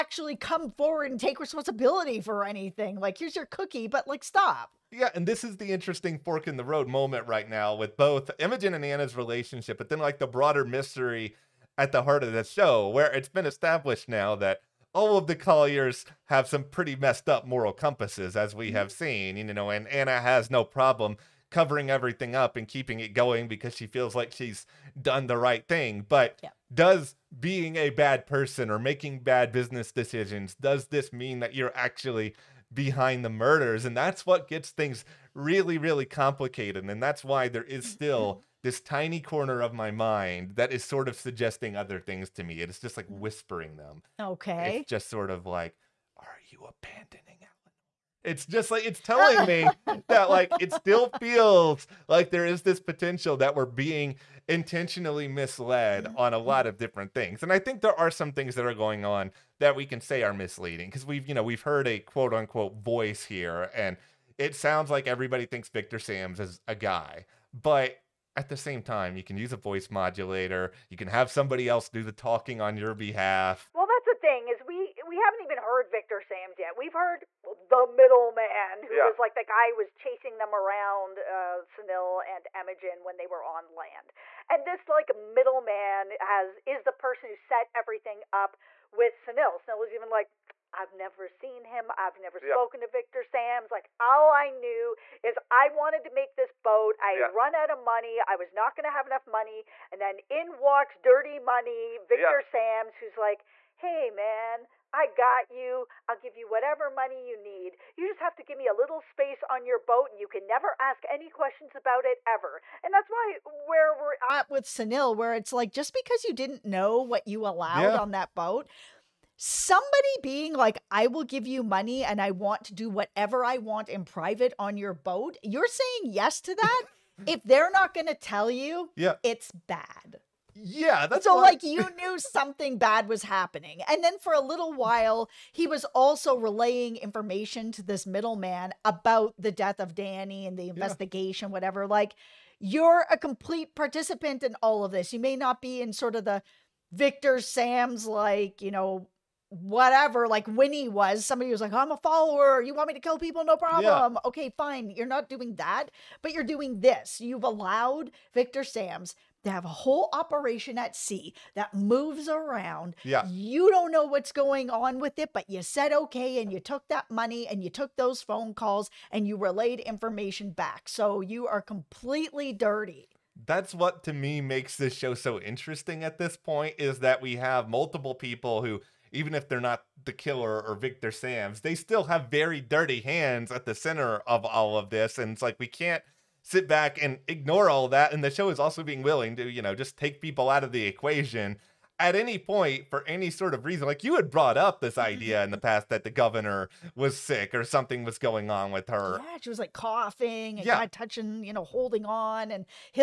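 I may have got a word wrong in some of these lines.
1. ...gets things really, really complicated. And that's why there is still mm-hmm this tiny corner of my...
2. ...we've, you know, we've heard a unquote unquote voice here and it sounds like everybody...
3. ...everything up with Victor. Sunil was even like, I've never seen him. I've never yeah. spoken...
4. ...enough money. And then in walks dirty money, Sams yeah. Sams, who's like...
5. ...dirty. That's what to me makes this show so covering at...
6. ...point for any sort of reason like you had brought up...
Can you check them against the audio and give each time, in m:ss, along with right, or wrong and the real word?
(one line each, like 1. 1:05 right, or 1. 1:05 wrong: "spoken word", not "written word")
1. 0:34 right
2. 1:01 wrong: "quote", not "unquote"
3. 1:27 wrong: "Sunil", not "Victor"
4. 1:39 wrong: "Victor", not "Sams"
5. 2:52 wrong: "interesting", not "covering"
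6. 3:12 right.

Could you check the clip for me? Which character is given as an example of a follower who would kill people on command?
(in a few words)
Winnie.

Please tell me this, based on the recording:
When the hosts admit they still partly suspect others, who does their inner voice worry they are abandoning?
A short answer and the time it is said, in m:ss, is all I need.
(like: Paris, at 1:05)
Eleanor, at 0:47.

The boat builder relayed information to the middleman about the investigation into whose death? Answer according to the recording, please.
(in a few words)
Danny.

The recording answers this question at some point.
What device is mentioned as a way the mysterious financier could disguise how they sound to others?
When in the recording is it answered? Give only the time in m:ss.
1:09.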